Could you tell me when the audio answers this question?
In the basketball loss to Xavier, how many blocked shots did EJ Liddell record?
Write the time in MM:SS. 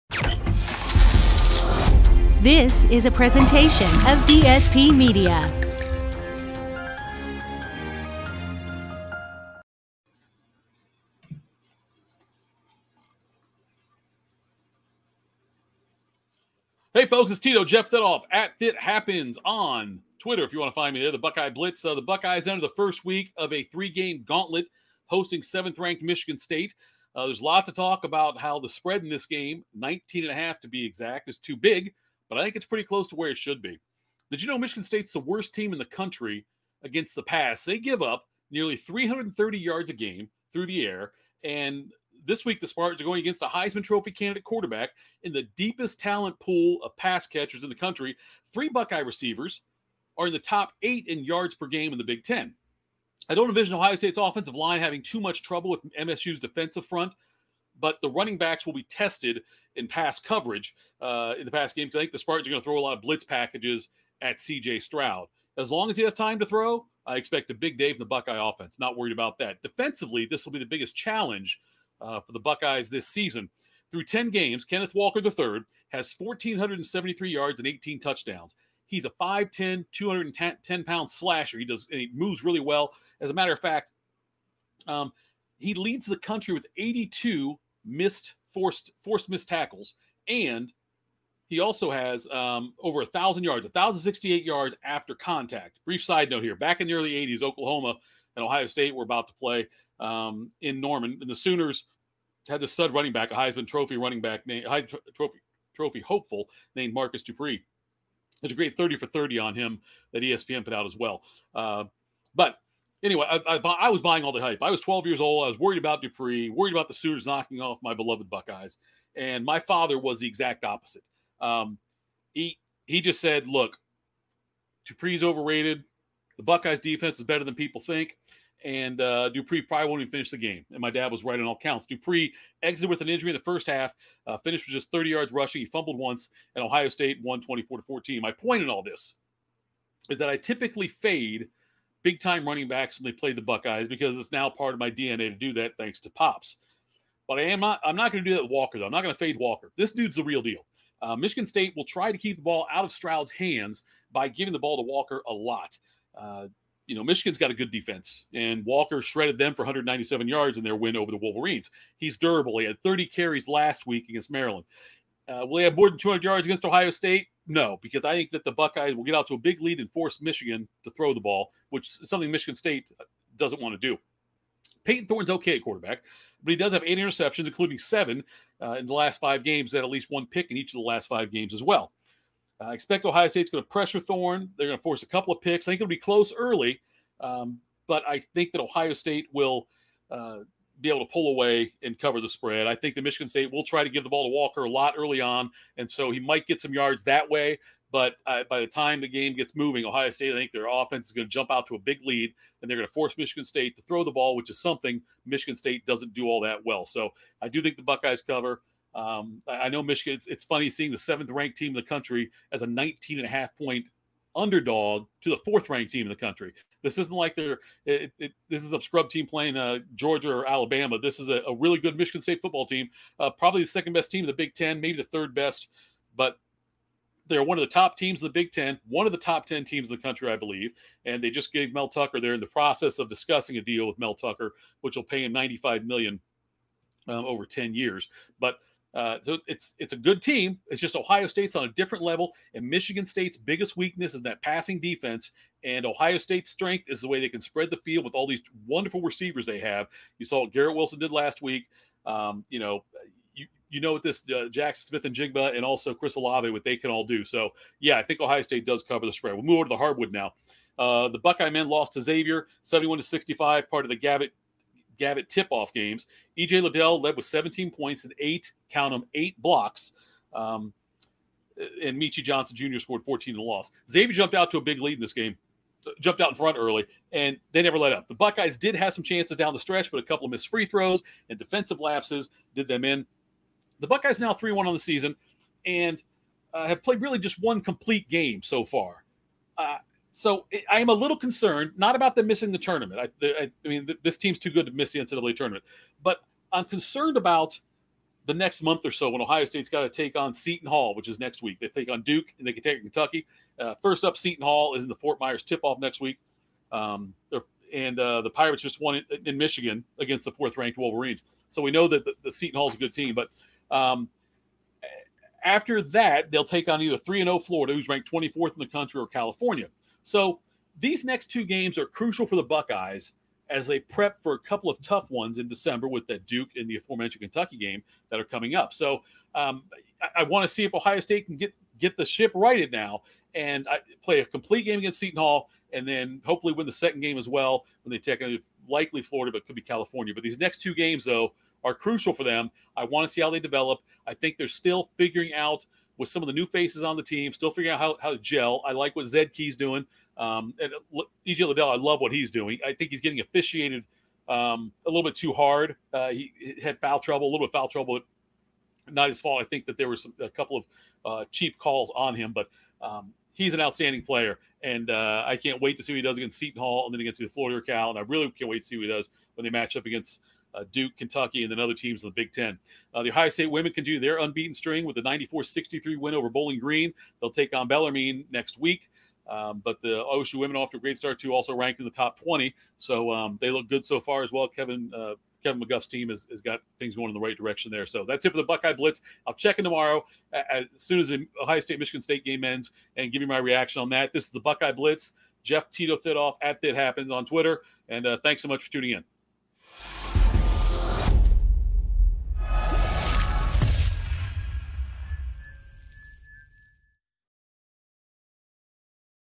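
04:29.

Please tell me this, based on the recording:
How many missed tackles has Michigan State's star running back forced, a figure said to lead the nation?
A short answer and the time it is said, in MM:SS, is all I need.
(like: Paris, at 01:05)
82, at 01:26.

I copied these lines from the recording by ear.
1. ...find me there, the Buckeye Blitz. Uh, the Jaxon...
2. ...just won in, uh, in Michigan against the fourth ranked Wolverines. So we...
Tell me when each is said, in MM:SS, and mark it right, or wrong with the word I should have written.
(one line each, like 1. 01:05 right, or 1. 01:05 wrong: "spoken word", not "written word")
1. 00:20 wrong: "Buckeyes", not "Jaxon"
2. 05:08 right.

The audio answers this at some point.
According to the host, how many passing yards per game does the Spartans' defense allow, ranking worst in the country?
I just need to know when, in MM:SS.
00:38.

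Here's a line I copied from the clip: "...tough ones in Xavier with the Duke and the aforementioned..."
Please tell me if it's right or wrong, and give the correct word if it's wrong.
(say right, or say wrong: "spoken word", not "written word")
wrong: "December", not "Xavier".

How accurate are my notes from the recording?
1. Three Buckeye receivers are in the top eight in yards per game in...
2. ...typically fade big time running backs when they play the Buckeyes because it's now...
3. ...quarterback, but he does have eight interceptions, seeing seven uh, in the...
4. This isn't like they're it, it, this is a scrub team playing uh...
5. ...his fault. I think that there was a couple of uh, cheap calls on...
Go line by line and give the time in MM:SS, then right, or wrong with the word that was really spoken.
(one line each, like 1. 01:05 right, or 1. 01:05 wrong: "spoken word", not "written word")
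1. 00:48 right
2. 02:20 right
3. 02:55 wrong: "including", not "seeing"
4. 03:36 right
5. 05:59 right.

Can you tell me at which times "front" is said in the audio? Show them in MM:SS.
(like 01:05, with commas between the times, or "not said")
00:56, 04:36.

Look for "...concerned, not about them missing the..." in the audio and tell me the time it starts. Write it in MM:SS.
04:51.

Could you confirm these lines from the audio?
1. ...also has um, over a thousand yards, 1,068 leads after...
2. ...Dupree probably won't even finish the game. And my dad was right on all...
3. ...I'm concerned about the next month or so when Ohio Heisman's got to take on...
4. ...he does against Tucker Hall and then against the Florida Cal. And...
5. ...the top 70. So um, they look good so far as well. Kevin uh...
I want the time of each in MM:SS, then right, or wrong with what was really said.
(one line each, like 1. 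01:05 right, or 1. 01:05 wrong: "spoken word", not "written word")
1. 01:31 wrong: "yards", not "leads"
2. 02:09 right
3. 04:56 wrong: "State", not "Heisman"
4. 06:05 wrong: "Seton", not "Tucker"
5. 06:21 wrong: "20", not "70".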